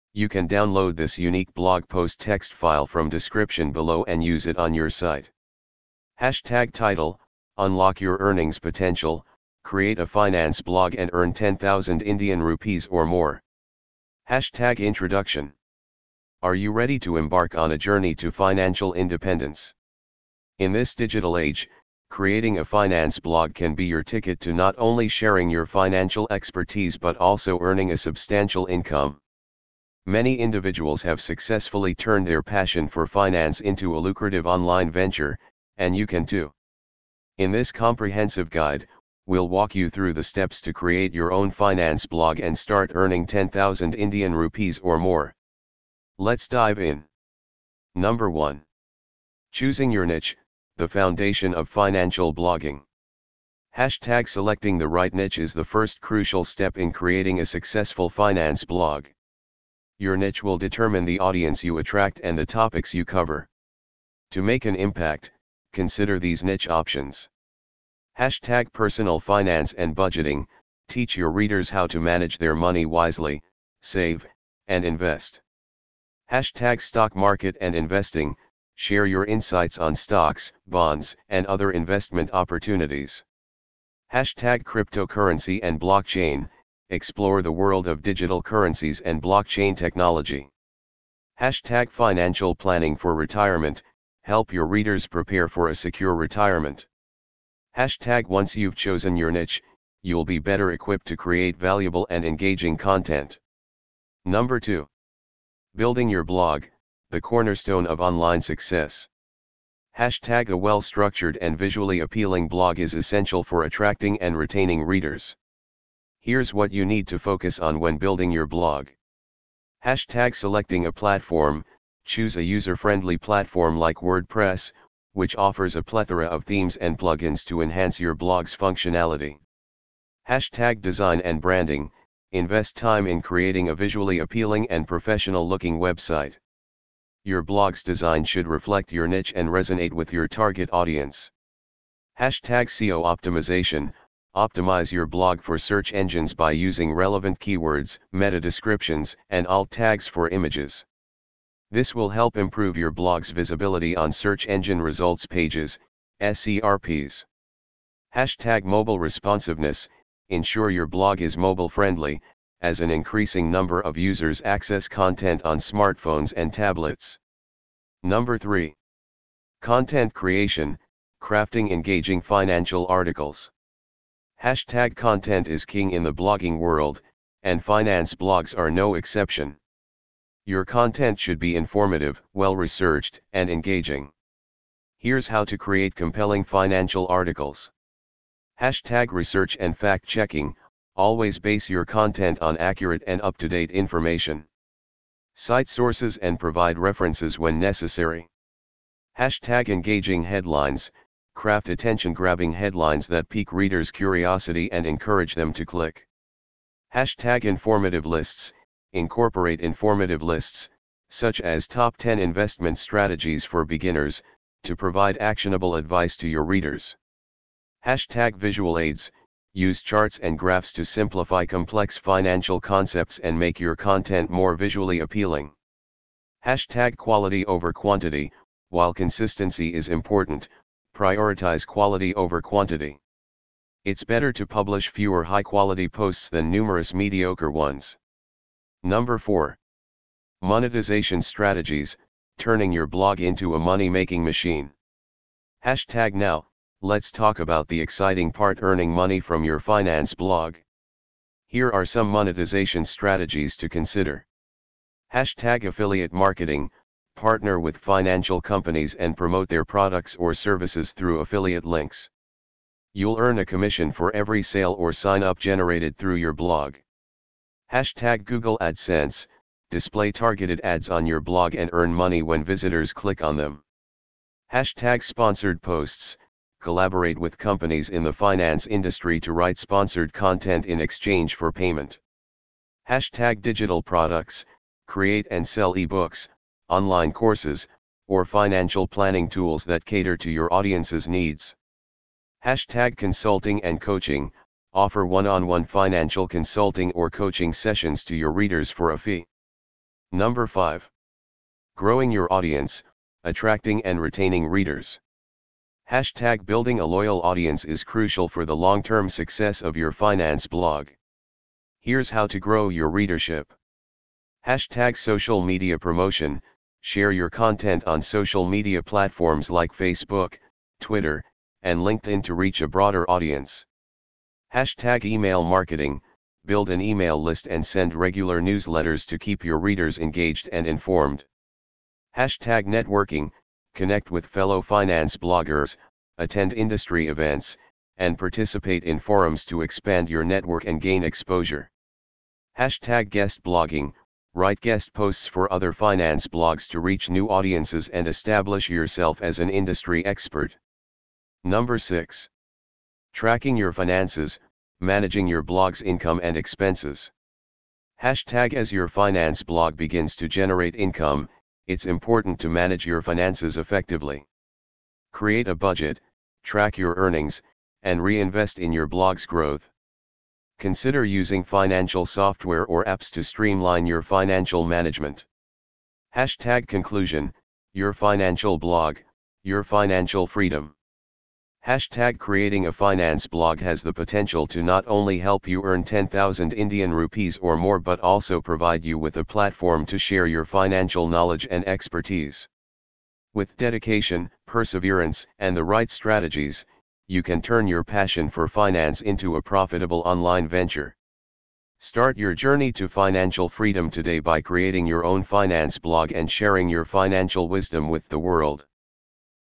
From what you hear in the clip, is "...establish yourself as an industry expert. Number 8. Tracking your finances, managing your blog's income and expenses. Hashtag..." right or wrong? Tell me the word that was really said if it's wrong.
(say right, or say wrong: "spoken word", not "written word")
wrong: "6", not "8".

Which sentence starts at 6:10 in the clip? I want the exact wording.
Consider using financial software or apps to streamline your financial management.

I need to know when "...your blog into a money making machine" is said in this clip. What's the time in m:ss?
4:02.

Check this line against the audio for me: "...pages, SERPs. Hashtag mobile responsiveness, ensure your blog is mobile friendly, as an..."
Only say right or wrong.
right.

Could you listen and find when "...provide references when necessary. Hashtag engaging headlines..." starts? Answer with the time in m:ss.
3:16.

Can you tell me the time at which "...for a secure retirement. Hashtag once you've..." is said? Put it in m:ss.
1:35.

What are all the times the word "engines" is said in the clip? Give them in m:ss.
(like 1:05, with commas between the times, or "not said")
2:25, 2:34.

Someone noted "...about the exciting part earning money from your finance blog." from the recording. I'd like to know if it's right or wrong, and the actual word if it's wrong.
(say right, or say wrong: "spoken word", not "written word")
right.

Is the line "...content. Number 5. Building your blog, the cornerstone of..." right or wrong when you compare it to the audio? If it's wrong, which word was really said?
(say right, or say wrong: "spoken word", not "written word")
wrong: "2", not "5".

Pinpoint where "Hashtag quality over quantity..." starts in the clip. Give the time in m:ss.
3:46.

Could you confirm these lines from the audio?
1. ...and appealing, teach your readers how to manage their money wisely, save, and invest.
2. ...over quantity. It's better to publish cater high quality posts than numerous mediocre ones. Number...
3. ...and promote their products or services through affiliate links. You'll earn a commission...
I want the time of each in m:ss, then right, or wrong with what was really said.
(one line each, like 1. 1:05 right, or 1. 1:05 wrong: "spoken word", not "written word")
1. 1:09 wrong: "budgeting", not "appealing"
2. 3:52 wrong: "fewer", not "cater"
3. 4:18 right.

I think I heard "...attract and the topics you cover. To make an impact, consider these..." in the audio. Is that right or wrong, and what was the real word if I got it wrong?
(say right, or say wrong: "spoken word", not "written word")
right.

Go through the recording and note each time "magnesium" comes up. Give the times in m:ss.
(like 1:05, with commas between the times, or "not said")
not said.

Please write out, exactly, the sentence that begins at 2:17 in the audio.
Your blog's design should reflect your niche and resonate with your target audience.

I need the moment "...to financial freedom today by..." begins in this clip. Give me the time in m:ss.
6:42.